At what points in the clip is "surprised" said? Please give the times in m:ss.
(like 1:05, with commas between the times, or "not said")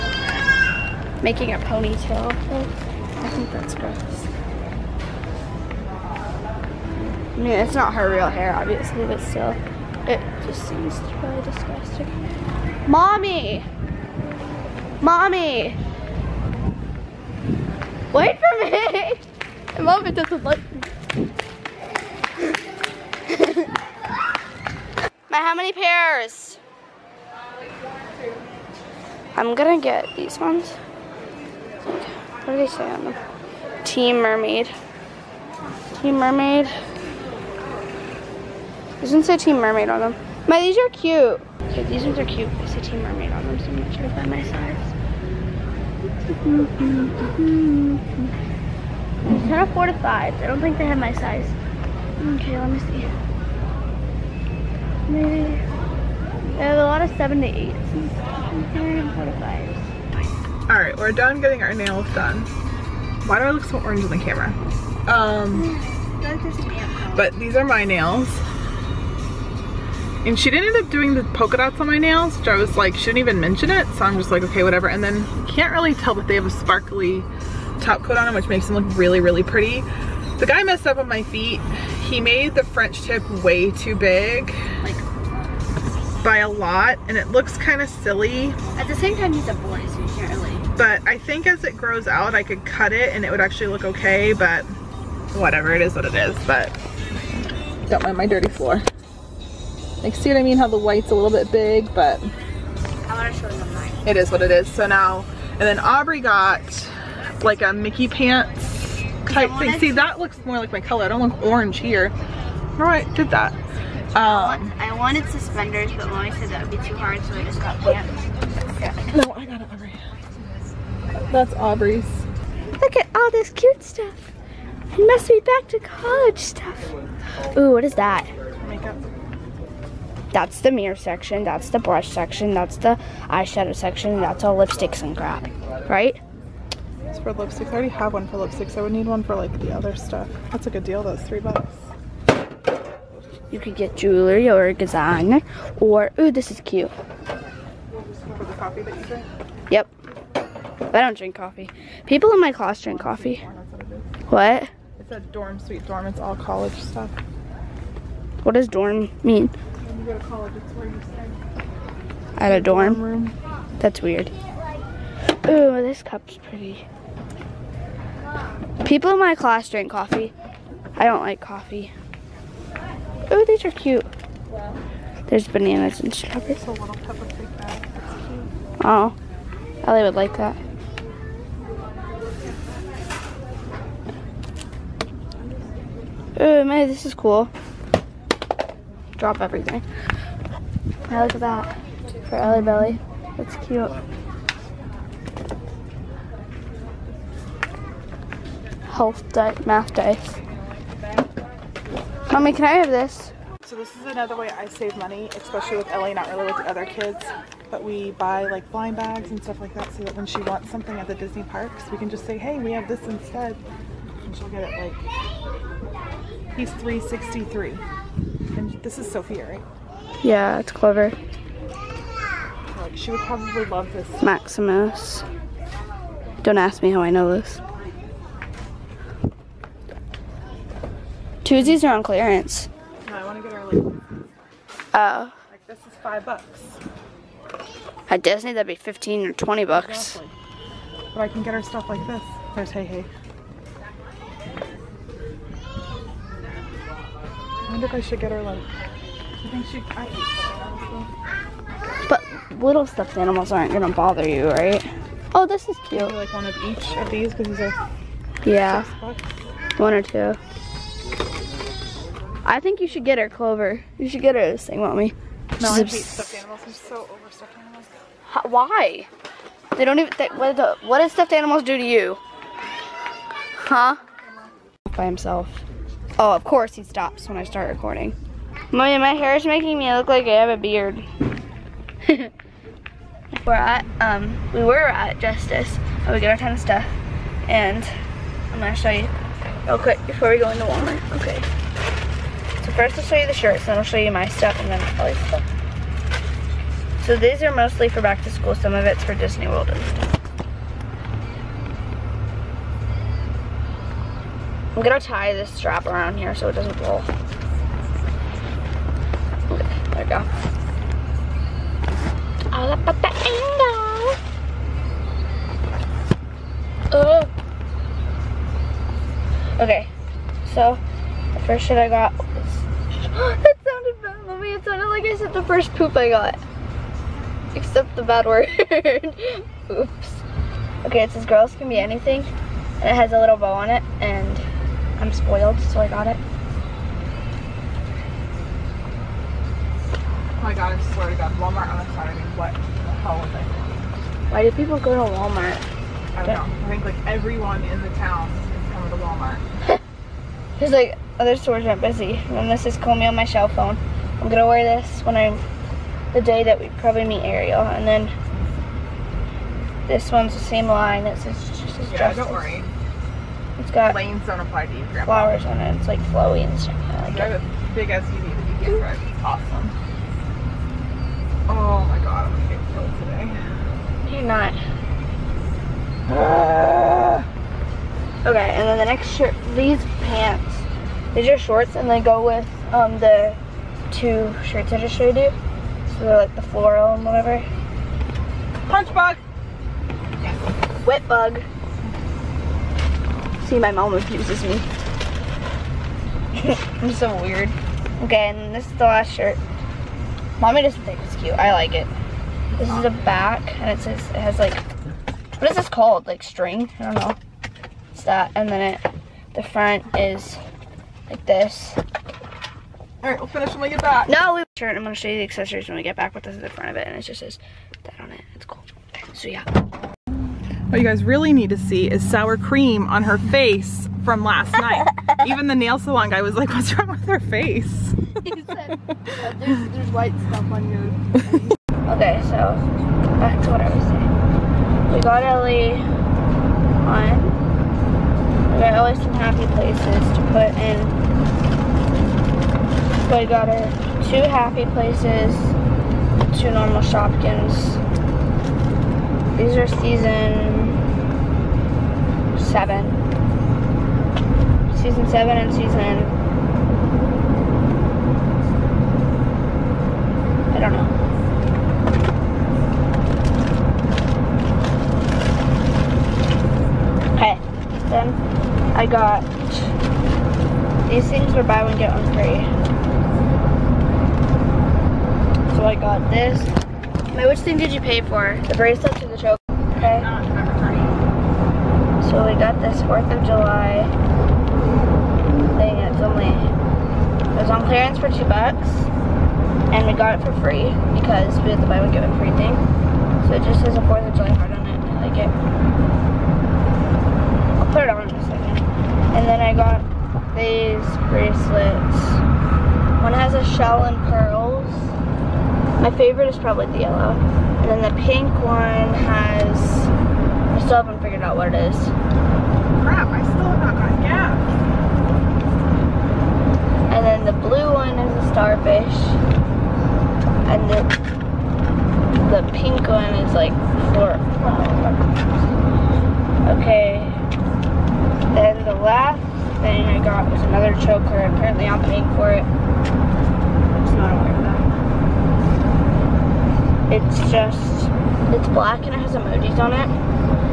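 not said.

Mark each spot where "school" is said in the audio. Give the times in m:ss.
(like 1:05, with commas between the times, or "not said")
4:58.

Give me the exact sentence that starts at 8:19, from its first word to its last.
And then I got these bracelets.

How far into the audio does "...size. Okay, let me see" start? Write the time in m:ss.
0:51.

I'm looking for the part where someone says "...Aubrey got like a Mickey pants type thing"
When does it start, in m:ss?
1:45.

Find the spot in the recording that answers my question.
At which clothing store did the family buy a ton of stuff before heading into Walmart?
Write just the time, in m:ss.
4:45.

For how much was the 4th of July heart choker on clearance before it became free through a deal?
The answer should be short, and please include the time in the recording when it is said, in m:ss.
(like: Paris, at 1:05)
2 dollars, at 8:08.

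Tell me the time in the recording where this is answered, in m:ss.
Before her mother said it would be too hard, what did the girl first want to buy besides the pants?
1:55.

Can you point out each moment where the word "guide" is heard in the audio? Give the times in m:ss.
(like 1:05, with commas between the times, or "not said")
not said.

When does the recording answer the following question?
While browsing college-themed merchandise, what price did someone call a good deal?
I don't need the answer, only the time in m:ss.
2:21.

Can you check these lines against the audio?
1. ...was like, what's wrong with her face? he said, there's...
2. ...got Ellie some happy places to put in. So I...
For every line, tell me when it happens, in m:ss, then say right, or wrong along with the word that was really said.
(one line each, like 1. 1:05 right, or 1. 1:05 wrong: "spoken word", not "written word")
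1. 7:06 right
2. 7:18 right.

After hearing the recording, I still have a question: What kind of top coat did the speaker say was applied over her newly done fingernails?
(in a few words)
sparkly.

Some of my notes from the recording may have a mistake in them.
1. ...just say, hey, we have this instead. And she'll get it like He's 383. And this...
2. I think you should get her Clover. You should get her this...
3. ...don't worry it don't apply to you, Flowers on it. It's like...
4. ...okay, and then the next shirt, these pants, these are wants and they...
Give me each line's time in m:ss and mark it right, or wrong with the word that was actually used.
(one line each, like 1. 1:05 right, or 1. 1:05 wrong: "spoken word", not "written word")
1. 3:32 wrong: "363", not "383"
2. 4:22 right
3. 6:02 right
4. 6:18 wrong: "shorts", not "wants".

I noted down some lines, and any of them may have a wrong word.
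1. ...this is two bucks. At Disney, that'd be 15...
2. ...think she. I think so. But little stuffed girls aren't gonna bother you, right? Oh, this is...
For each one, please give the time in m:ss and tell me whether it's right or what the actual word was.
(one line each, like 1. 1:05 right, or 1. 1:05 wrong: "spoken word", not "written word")
1. 3:55 wrong: "five", not "two"
2. 4:09 wrong: "animals", not "girls".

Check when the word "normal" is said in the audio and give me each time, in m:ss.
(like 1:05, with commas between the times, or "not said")
7:26.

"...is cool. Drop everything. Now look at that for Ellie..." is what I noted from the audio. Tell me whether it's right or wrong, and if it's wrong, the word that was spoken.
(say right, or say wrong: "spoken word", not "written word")
right.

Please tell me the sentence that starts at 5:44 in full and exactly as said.
Why do people go to Walmart?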